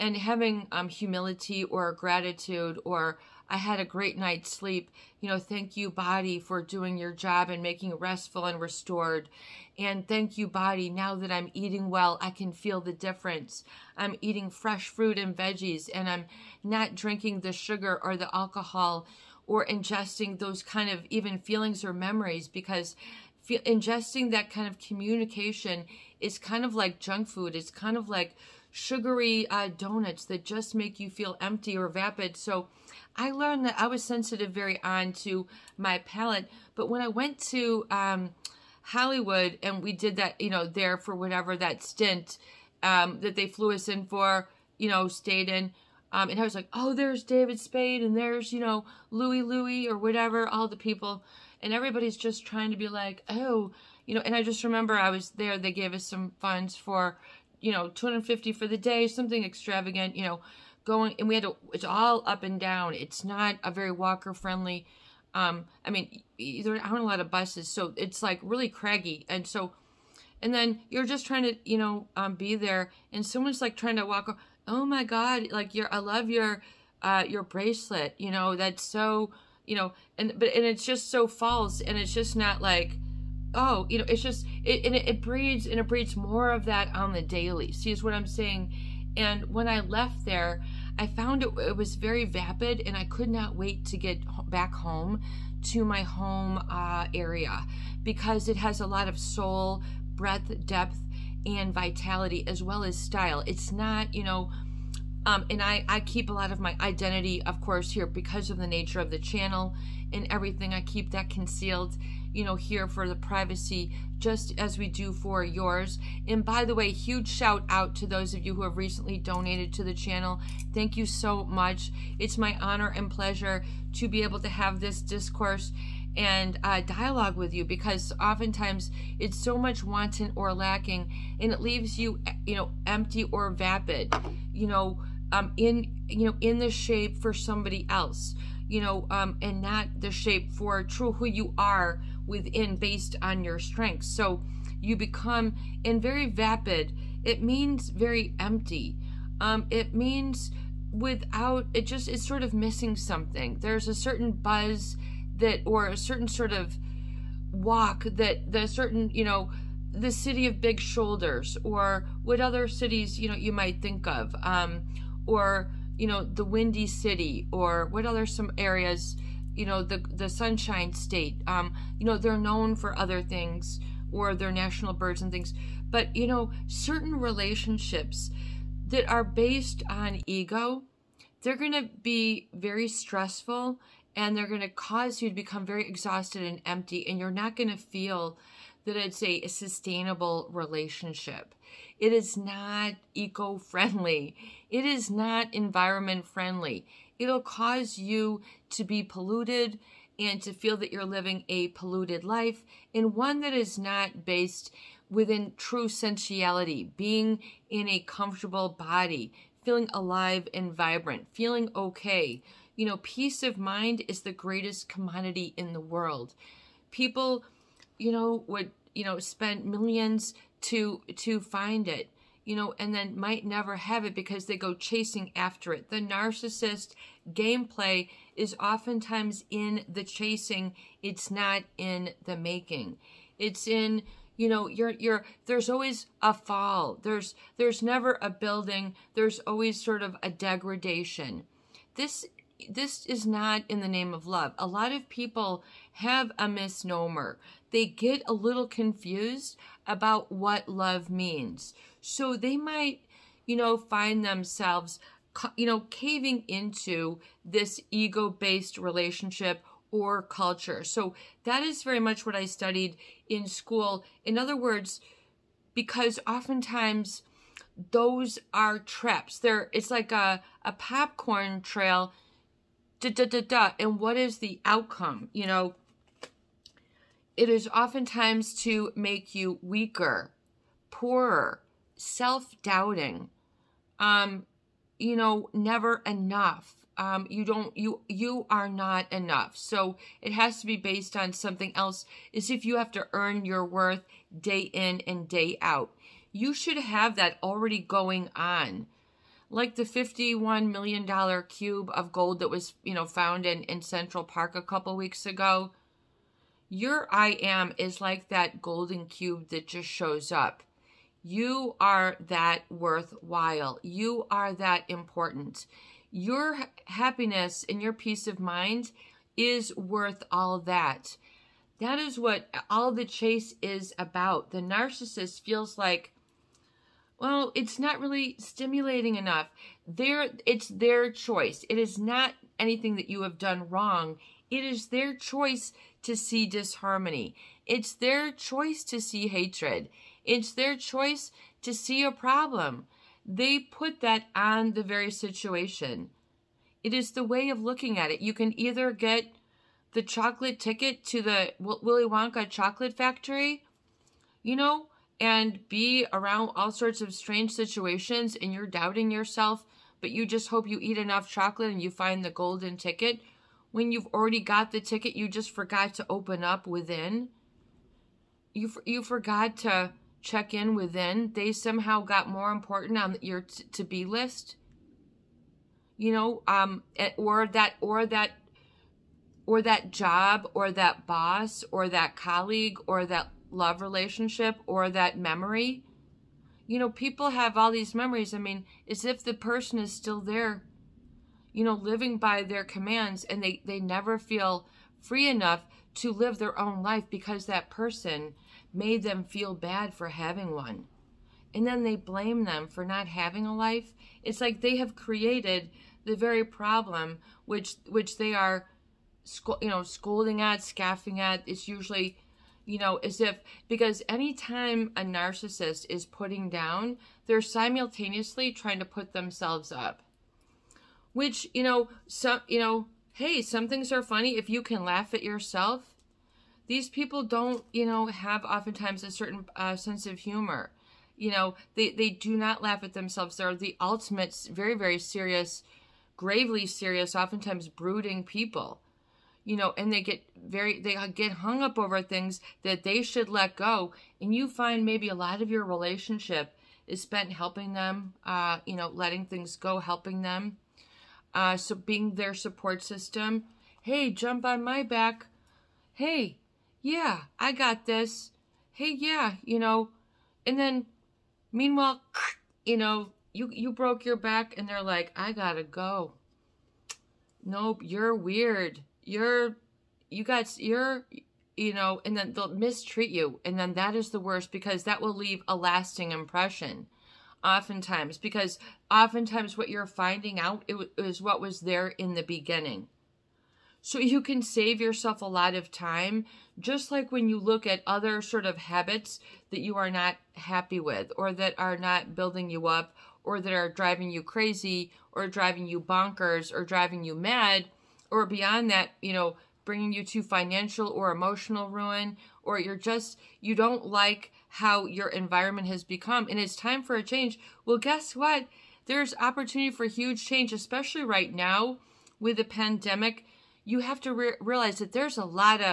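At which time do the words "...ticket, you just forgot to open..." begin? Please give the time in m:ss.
6:04.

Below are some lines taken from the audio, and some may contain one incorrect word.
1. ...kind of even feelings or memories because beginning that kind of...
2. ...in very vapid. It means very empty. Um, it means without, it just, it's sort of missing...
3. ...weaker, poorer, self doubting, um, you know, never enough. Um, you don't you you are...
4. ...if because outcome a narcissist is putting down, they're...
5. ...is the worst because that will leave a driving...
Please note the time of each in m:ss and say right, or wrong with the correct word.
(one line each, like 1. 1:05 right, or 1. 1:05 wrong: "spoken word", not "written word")
1. 0:20 wrong: "ingesting", not "beginning"
2. 2:25 right
3. 4:39 right
4. 6:53 wrong: "anytime", not "outcome"
5. 7:53 wrong: "lasting", not "driving".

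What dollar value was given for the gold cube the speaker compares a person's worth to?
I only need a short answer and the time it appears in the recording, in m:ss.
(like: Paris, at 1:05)
51 million dollars, at 4:59.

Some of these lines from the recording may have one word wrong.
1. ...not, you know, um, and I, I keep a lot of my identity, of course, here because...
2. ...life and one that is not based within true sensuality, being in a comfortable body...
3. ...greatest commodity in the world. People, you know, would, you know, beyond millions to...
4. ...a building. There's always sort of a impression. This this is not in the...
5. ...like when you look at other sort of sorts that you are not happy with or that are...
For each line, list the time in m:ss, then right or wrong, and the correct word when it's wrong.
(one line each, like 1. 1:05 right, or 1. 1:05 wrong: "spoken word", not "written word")
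1. 1:43 right
2. 3:22 right
3. 3:34 wrong: "spend", not "beyond"
4. 3:58 wrong: "degradation", not "impression"
5. 8:06 wrong: "habits", not "sorts".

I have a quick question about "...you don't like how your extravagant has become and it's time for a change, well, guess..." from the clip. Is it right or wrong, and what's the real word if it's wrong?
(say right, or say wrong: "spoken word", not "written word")
wrong: "environment", not "extravagant".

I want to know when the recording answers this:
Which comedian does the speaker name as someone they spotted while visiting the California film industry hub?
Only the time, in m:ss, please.
0:47.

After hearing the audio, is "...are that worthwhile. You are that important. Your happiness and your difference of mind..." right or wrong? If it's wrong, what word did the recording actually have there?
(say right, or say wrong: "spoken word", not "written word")
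wrong: "peace", not "difference".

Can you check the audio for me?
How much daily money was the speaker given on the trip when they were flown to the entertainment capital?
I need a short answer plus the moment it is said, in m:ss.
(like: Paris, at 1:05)
250, at 0:57.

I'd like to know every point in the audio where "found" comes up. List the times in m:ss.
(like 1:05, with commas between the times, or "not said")
1:31, 5:03.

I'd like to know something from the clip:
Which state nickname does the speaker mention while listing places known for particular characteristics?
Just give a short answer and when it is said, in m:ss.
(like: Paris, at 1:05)
The Sunshine State, at 2:50.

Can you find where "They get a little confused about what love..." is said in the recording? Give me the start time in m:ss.
4:07.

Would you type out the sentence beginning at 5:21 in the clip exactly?
That is what all the chase is about.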